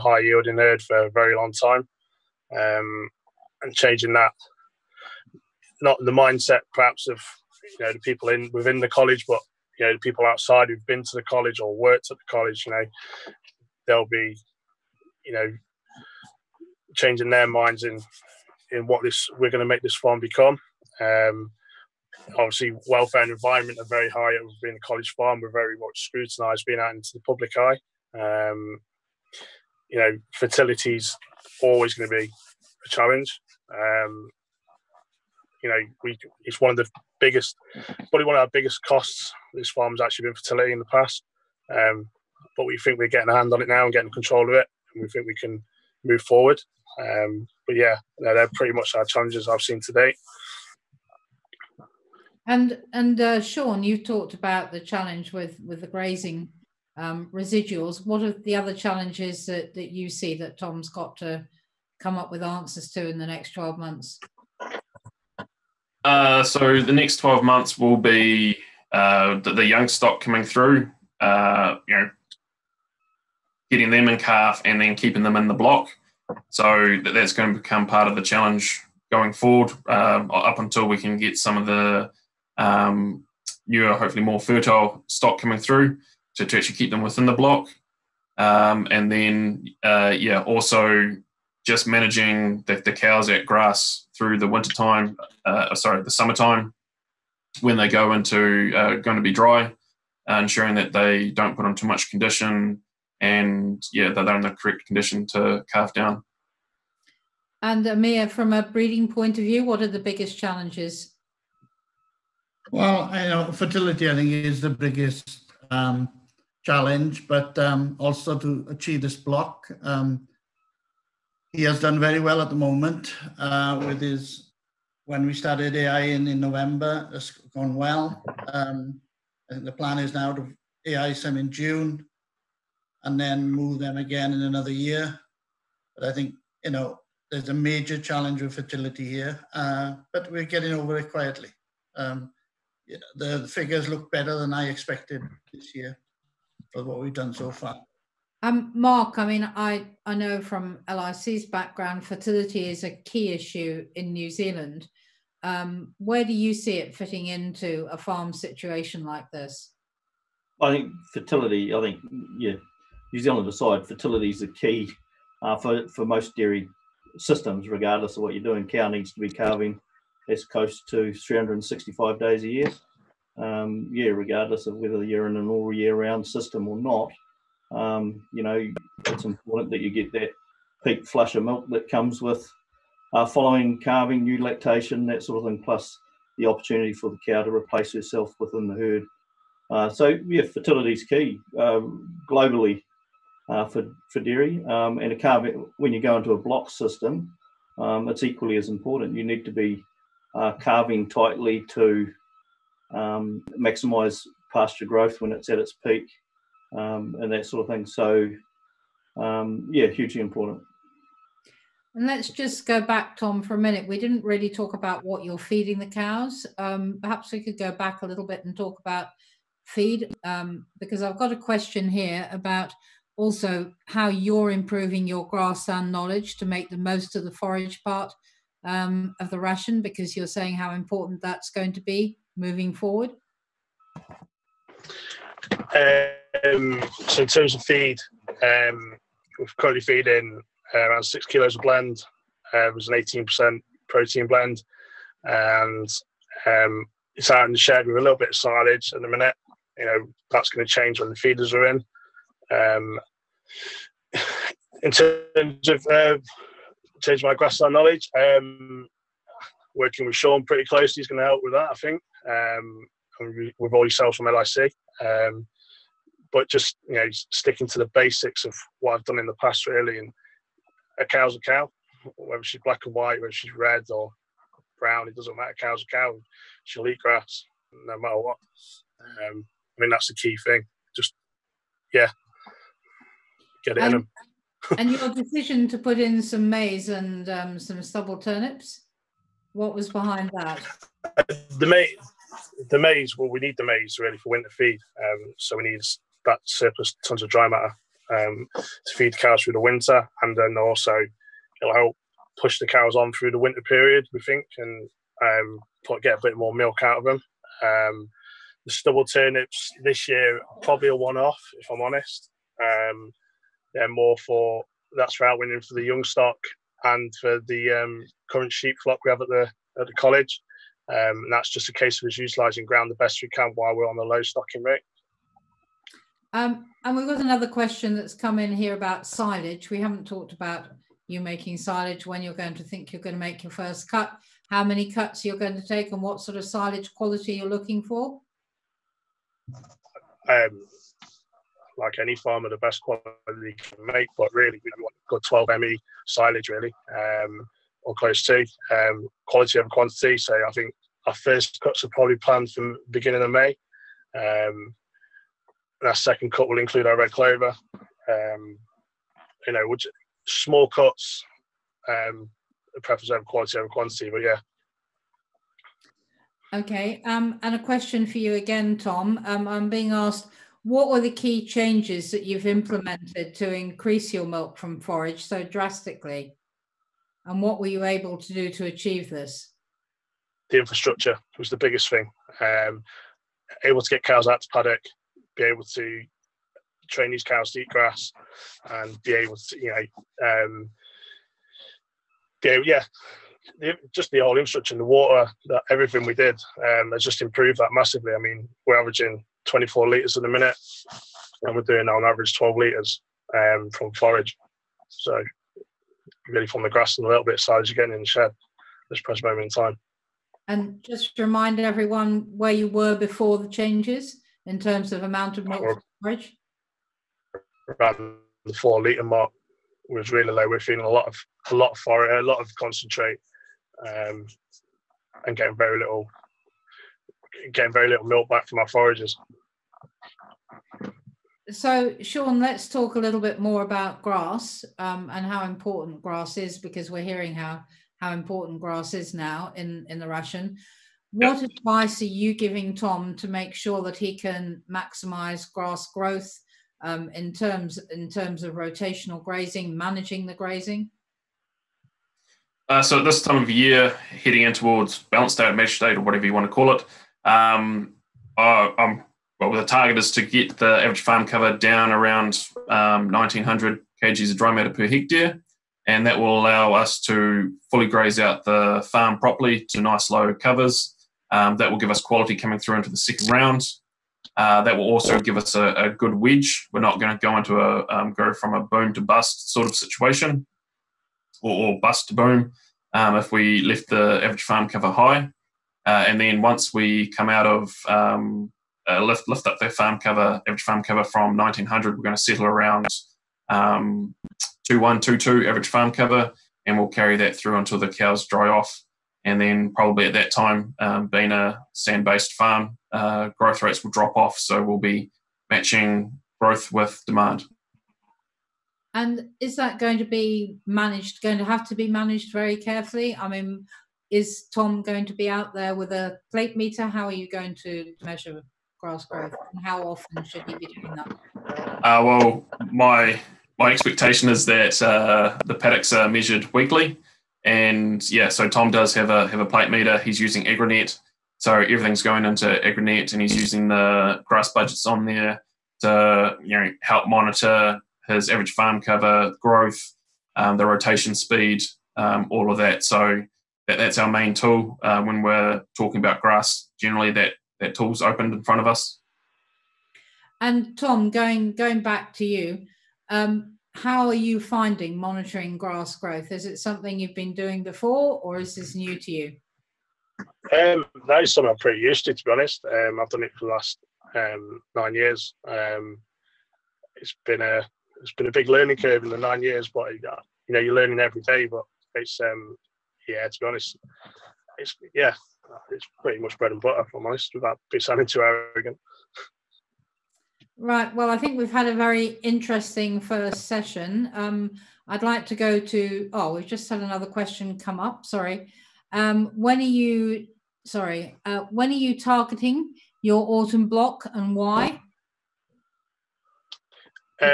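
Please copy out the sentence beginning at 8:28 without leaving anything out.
And is that going to be managed, going to have to be managed very carefully?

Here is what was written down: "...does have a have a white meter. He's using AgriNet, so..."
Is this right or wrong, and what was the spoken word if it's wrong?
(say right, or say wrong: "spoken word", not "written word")
wrong: "plate", not "white".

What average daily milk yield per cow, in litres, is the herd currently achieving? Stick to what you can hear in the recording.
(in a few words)
24 litres.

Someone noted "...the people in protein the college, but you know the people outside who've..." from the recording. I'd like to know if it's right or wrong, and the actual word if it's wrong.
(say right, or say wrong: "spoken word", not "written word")
wrong: "within", not "protein".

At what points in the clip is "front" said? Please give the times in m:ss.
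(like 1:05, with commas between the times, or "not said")
9:08.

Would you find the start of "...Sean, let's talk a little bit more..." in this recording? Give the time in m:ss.
7:12.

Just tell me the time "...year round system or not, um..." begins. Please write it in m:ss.
2:55.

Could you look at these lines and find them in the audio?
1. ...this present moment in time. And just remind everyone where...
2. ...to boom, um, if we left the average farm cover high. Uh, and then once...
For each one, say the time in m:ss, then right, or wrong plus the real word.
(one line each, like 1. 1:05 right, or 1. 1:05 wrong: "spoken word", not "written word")
1. 6:48 right
2. 8:02 right.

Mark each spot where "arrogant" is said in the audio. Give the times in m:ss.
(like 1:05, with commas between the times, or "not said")
9:38.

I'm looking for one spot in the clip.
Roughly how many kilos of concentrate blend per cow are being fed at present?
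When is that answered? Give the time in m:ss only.
4:01.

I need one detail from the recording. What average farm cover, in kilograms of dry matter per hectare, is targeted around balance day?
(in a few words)
1900.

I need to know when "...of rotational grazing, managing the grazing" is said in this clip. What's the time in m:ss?
7:28.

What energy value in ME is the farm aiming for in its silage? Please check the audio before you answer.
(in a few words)
12.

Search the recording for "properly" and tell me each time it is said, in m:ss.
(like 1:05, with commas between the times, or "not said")
7:49.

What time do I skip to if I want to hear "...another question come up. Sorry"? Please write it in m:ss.
9:46.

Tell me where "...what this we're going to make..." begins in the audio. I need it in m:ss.
0:18.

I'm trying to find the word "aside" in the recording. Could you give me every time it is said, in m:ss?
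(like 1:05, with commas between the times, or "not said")
2:43.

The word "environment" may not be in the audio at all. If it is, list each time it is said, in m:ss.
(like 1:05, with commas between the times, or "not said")
0:23.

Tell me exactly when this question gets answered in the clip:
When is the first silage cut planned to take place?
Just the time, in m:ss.
5:52.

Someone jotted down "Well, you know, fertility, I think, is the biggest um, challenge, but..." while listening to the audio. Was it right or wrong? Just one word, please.
right.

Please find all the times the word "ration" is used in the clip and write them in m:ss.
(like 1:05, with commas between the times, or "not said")
3:49, 7:20.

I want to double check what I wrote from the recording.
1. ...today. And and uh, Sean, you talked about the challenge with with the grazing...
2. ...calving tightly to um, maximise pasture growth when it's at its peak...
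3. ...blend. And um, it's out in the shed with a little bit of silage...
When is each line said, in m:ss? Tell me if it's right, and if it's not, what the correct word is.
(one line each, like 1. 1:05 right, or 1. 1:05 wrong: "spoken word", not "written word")
1. 0:49 right
2. 3:20 right
3. 4:04 right.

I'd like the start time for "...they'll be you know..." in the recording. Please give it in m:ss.
0:13.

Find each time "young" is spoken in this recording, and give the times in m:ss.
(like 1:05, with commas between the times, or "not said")
1:09, 5:15.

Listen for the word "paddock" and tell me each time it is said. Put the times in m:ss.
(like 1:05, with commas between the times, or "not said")
6:24, 8:45.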